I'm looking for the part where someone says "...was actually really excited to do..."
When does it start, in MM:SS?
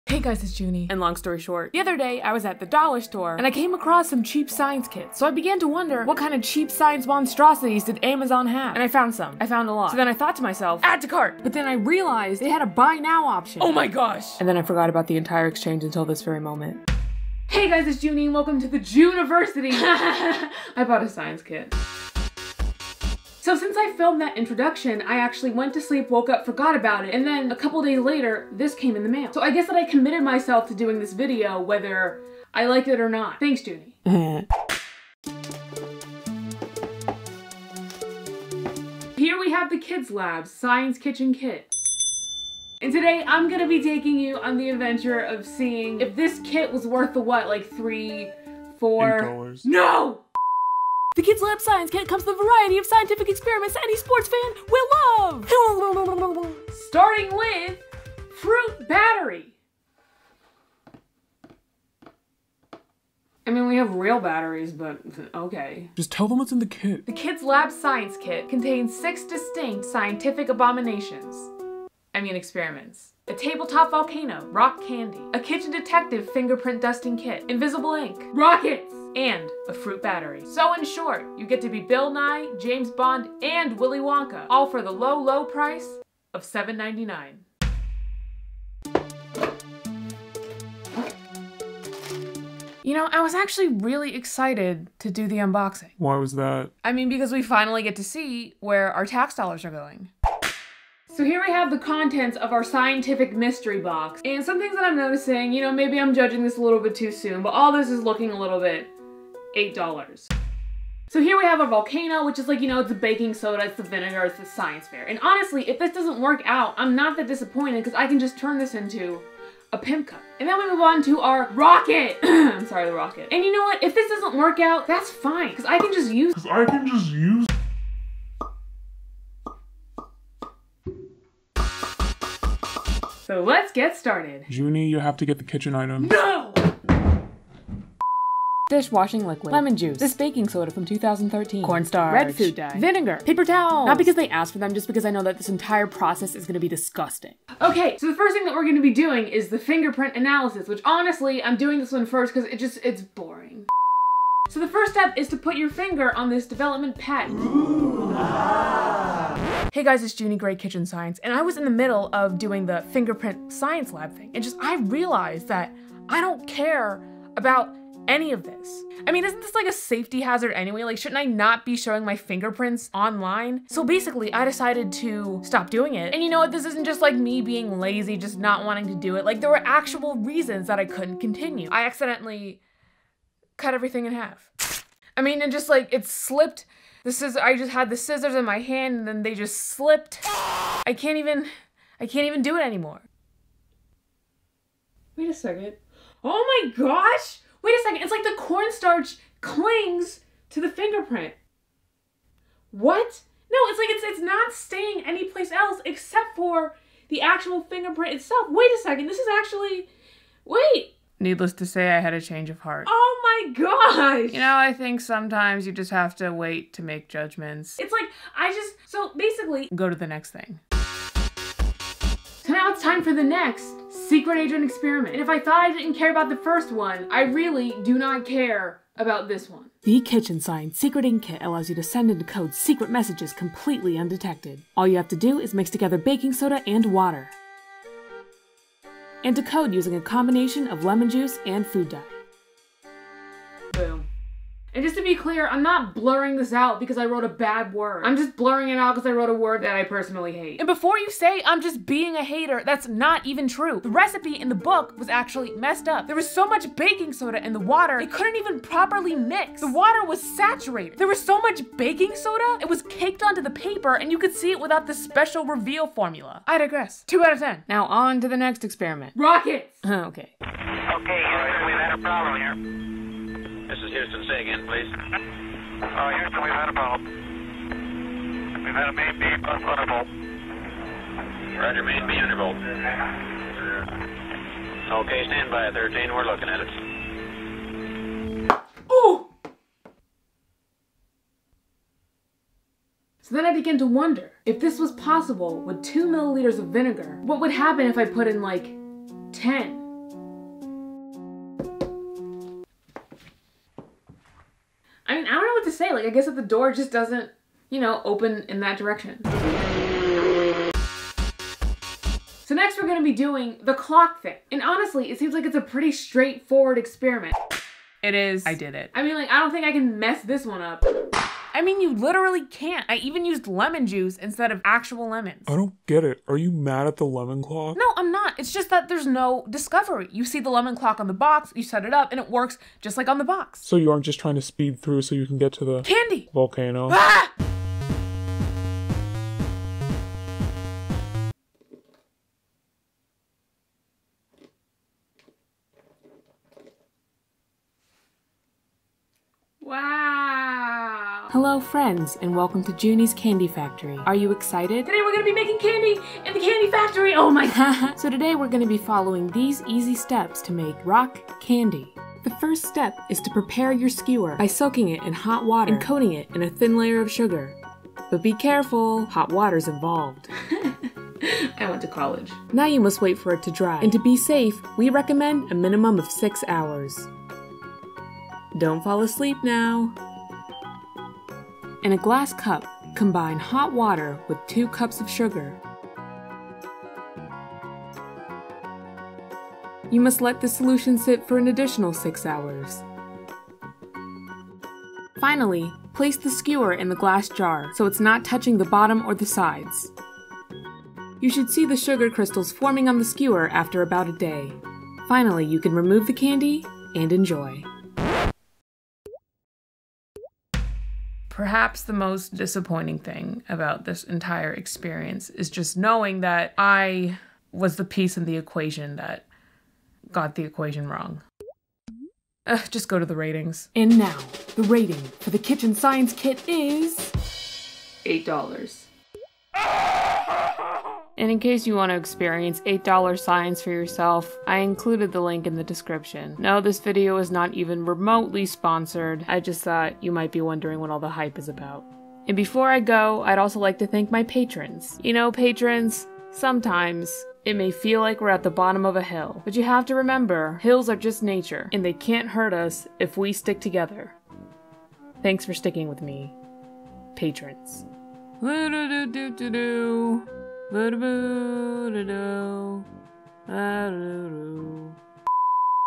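01:33.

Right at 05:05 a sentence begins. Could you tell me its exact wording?
I mean, I don't know what to say.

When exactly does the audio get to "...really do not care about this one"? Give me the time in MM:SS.
03:47.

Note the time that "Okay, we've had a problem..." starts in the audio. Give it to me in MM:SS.
04:30.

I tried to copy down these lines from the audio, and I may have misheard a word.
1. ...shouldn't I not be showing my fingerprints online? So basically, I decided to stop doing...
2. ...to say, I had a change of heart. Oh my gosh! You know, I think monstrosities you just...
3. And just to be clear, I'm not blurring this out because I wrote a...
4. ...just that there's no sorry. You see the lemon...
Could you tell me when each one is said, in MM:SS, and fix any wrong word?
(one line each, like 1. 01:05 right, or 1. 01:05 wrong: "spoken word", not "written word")
1. 02:50 right
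2. 03:31 wrong: "sometimes", not "monstrosities"
3. 04:04 right
4. 05:28 wrong: "discovery", not "sorry".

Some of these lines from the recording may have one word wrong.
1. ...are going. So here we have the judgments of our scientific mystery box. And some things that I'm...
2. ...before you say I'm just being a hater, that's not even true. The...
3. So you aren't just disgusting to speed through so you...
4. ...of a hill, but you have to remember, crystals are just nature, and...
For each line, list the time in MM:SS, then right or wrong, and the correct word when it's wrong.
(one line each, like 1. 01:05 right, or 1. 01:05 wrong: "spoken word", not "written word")
1. 01:39 wrong: "contents", not "judgments"
2. 04:10 right
3. 05:33 wrong: "trying", not "disgusting"
4. 07:28 wrong: "hills", not "crystals".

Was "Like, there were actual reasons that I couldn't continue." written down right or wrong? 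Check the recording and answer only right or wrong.
right.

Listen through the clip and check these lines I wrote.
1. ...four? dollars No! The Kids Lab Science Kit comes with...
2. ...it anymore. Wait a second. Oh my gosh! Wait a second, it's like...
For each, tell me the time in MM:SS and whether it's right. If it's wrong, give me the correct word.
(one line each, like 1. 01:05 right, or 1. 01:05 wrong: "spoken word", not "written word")
1. 00:48 right
2. 03:12 right.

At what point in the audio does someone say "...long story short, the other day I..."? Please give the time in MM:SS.
00:00.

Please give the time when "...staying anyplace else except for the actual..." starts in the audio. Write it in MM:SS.
03:24.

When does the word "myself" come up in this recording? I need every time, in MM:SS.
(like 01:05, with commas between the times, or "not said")
00:10, 00:30.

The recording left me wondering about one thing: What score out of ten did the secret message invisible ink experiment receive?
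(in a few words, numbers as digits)
2.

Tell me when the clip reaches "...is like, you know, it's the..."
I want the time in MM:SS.
01:52.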